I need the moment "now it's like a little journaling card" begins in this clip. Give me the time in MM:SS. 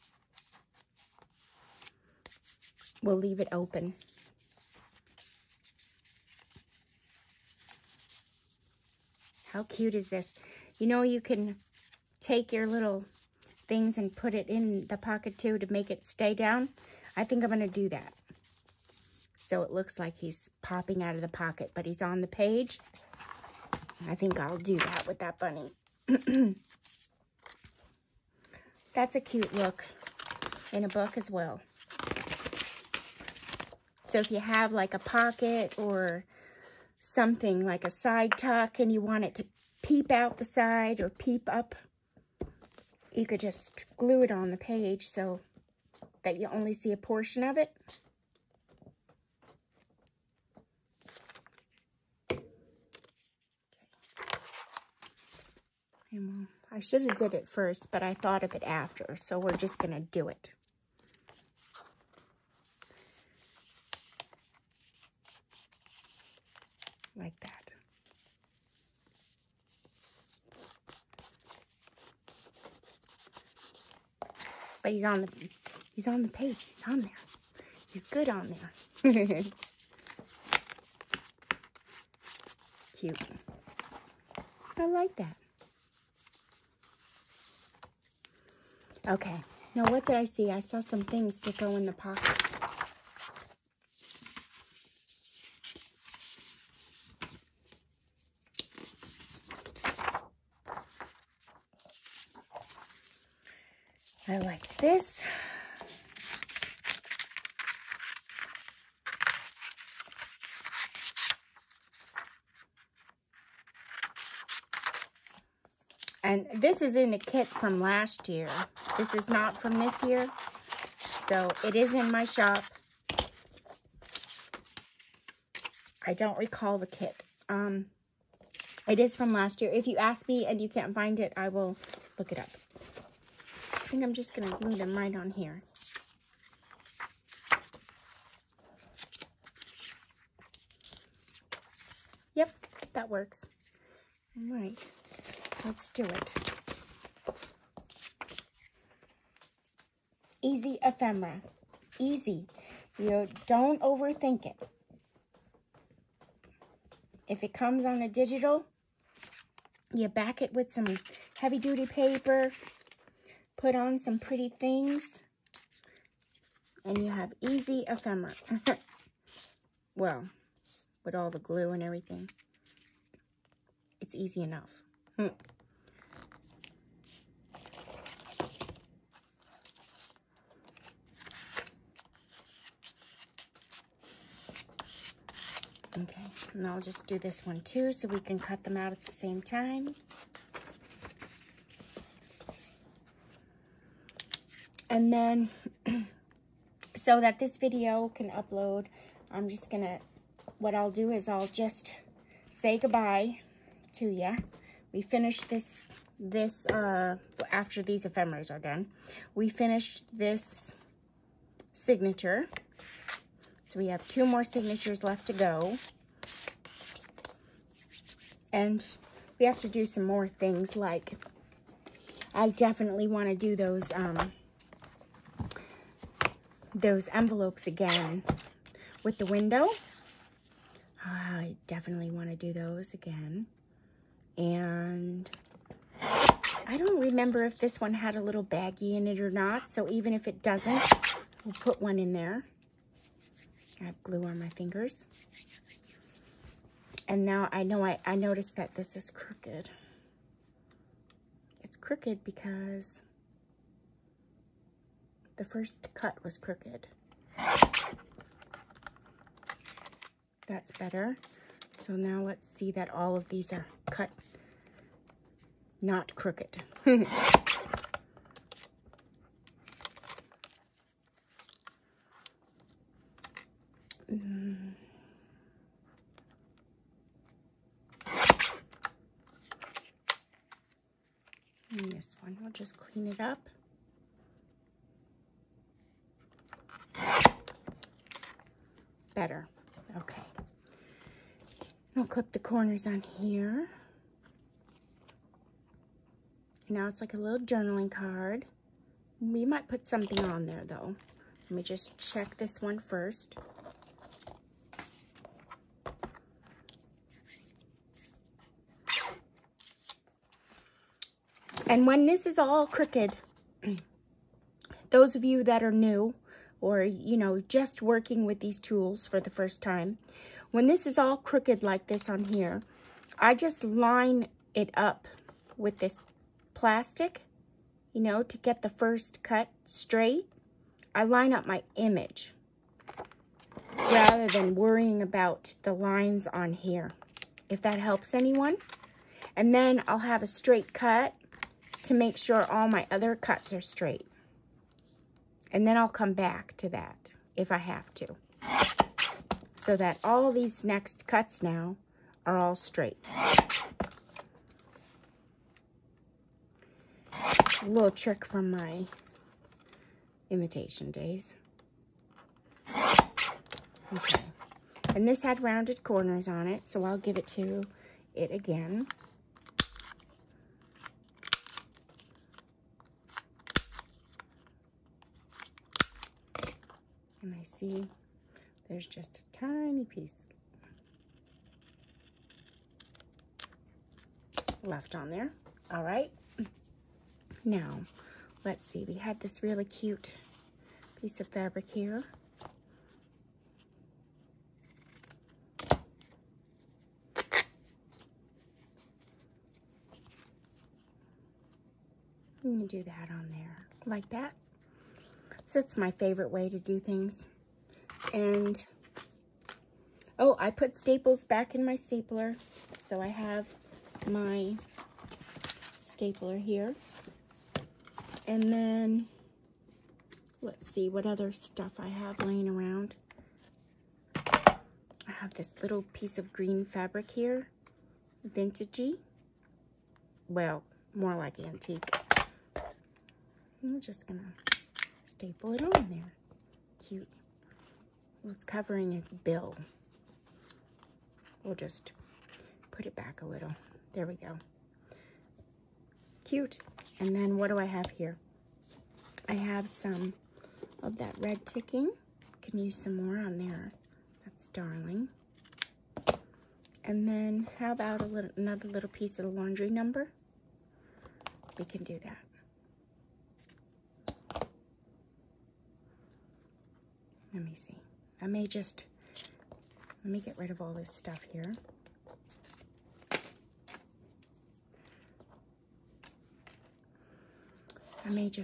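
04:56.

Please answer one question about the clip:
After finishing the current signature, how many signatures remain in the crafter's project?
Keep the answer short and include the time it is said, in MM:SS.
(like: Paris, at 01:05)
2, at 03:34.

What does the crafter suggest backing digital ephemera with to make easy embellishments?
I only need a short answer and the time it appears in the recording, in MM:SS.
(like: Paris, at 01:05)
Heavy duty paper, at 02:41.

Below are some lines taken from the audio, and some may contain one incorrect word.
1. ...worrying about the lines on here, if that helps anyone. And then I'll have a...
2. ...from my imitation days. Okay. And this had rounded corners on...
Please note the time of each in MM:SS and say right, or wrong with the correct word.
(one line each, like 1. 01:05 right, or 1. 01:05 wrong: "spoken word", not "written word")
1. 05:34 right
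2. 05:58 right.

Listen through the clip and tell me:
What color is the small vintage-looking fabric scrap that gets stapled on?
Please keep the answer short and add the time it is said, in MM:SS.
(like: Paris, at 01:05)
Green, at 07:06.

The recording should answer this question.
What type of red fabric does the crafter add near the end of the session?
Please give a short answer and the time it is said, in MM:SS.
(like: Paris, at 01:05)
Ticking, at 07:31.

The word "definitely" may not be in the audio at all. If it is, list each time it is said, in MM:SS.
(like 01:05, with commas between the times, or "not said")
03:42, 03:51.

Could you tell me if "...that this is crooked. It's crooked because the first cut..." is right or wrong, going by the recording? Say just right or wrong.
right.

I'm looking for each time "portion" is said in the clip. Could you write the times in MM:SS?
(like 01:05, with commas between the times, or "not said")
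00:46.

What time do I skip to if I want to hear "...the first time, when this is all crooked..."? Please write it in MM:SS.
05:19.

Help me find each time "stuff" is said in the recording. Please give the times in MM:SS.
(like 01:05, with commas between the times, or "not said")
07:01, 07:50.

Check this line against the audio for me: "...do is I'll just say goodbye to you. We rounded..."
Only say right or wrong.
wrong.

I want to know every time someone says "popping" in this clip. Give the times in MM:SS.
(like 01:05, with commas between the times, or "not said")
00:20.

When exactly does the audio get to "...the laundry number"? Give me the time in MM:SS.
07:39.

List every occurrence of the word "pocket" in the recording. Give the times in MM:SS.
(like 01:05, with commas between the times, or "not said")
00:14, 00:21, 00:34, 01:31.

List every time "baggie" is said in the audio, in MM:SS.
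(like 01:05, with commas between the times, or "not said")
03:58.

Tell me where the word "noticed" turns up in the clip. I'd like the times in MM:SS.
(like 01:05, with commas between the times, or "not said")
04:08.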